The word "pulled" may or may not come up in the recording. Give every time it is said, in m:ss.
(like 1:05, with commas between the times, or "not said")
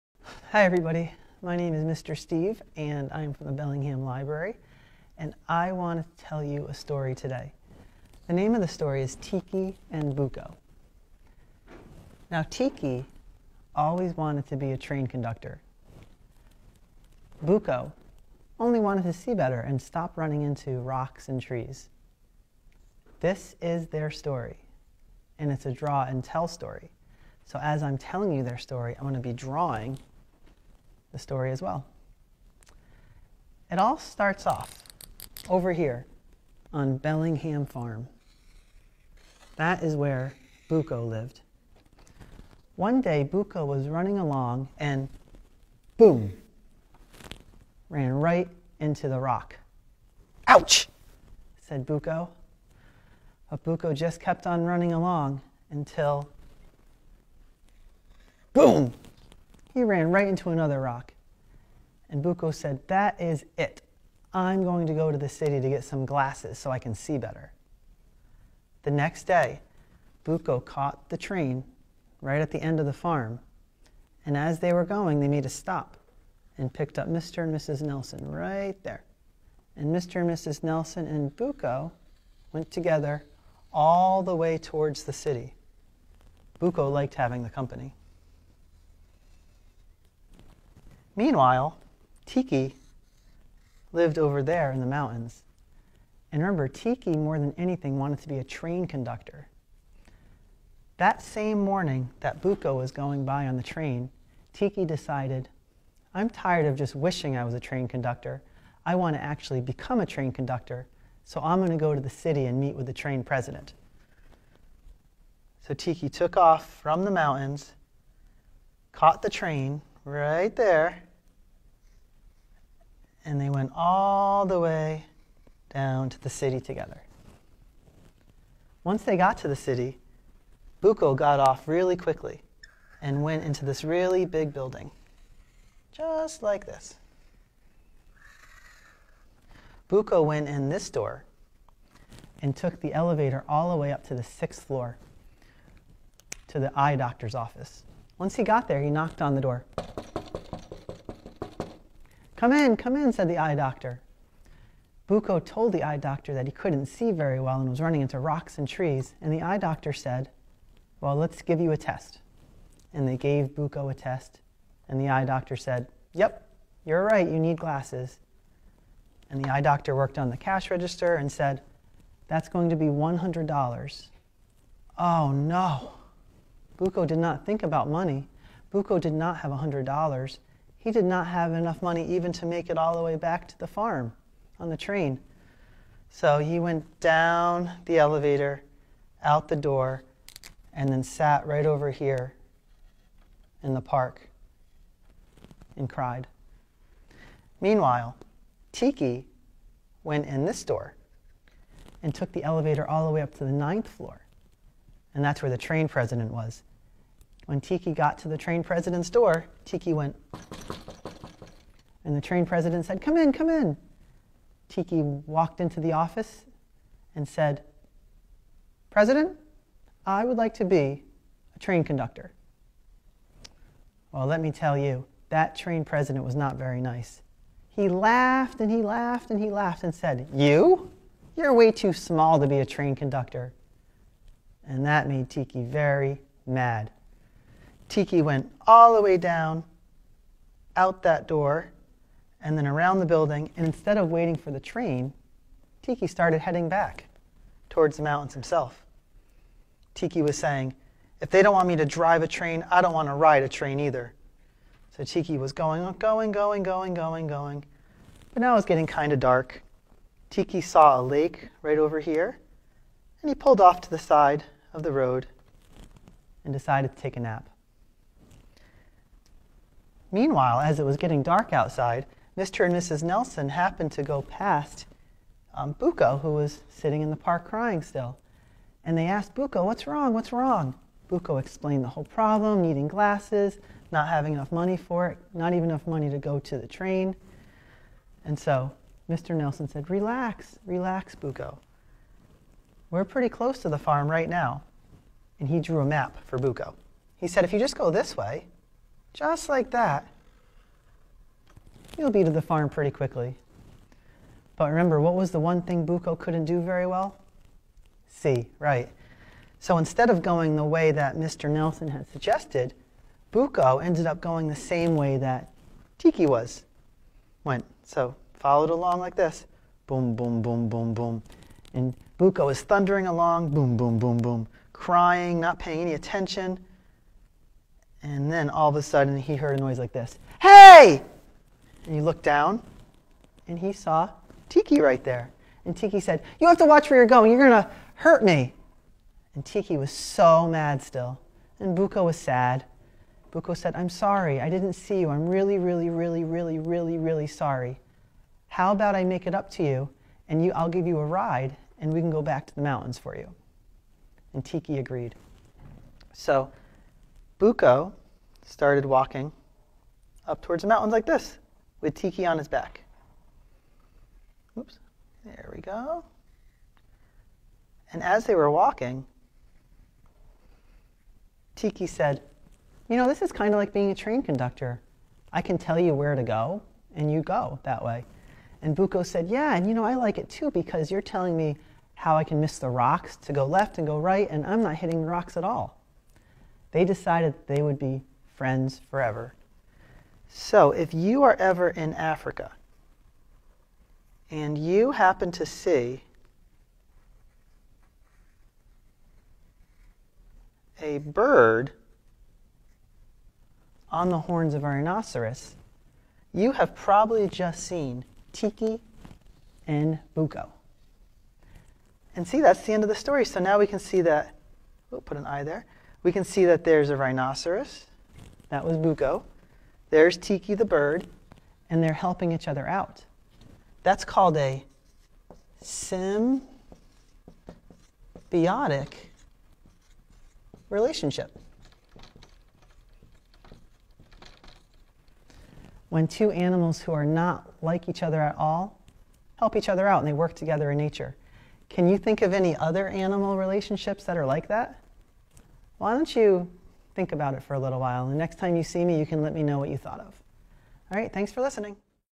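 4:23.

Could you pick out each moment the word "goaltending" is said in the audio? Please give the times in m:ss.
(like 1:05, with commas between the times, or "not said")
not said.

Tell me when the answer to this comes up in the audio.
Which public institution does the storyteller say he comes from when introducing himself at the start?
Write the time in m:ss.
0:03.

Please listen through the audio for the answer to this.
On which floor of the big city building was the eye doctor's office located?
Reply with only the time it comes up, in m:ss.
2:24.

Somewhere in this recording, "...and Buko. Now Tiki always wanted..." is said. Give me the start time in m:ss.
0:09.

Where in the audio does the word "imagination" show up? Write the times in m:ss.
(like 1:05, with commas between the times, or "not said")
not said.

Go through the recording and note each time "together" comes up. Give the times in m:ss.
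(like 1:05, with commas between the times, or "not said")
1:22, 2:06, 7:20.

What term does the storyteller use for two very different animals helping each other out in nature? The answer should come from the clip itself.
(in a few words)
Symbiotic relationship.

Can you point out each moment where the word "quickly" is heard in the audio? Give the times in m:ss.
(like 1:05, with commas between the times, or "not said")
2:11, 5:02.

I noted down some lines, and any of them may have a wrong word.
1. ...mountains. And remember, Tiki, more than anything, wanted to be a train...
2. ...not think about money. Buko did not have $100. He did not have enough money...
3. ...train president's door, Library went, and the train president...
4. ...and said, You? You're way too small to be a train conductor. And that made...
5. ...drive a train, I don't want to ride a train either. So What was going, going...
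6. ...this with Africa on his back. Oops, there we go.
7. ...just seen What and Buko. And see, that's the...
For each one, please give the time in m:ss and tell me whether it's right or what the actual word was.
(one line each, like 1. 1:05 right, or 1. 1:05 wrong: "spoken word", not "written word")
1. 1:34 right
2. 2:57 right
3. 3:28 wrong: "Tiki", not "Library"
4. 3:49 right
5. 4:11 wrong: "Tiki", not "What"
6. 6:01 wrong: "Tiki", not "Africa"
7. 6:47 wrong: "Tiki", not "What".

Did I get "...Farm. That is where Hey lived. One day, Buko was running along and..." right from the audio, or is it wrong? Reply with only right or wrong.
wrong.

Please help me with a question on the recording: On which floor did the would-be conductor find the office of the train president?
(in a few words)
Ninth floor.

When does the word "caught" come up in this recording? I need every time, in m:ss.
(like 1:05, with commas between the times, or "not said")
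1:10, 1:58.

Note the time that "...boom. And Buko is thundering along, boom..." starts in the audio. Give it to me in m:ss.
5:20.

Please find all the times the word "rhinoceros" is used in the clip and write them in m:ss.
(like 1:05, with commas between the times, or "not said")
6:44, 6:56.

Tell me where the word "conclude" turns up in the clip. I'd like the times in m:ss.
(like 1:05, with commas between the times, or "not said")
not said.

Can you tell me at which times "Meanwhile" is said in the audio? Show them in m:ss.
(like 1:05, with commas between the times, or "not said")
1:31, 3:17, 4:30.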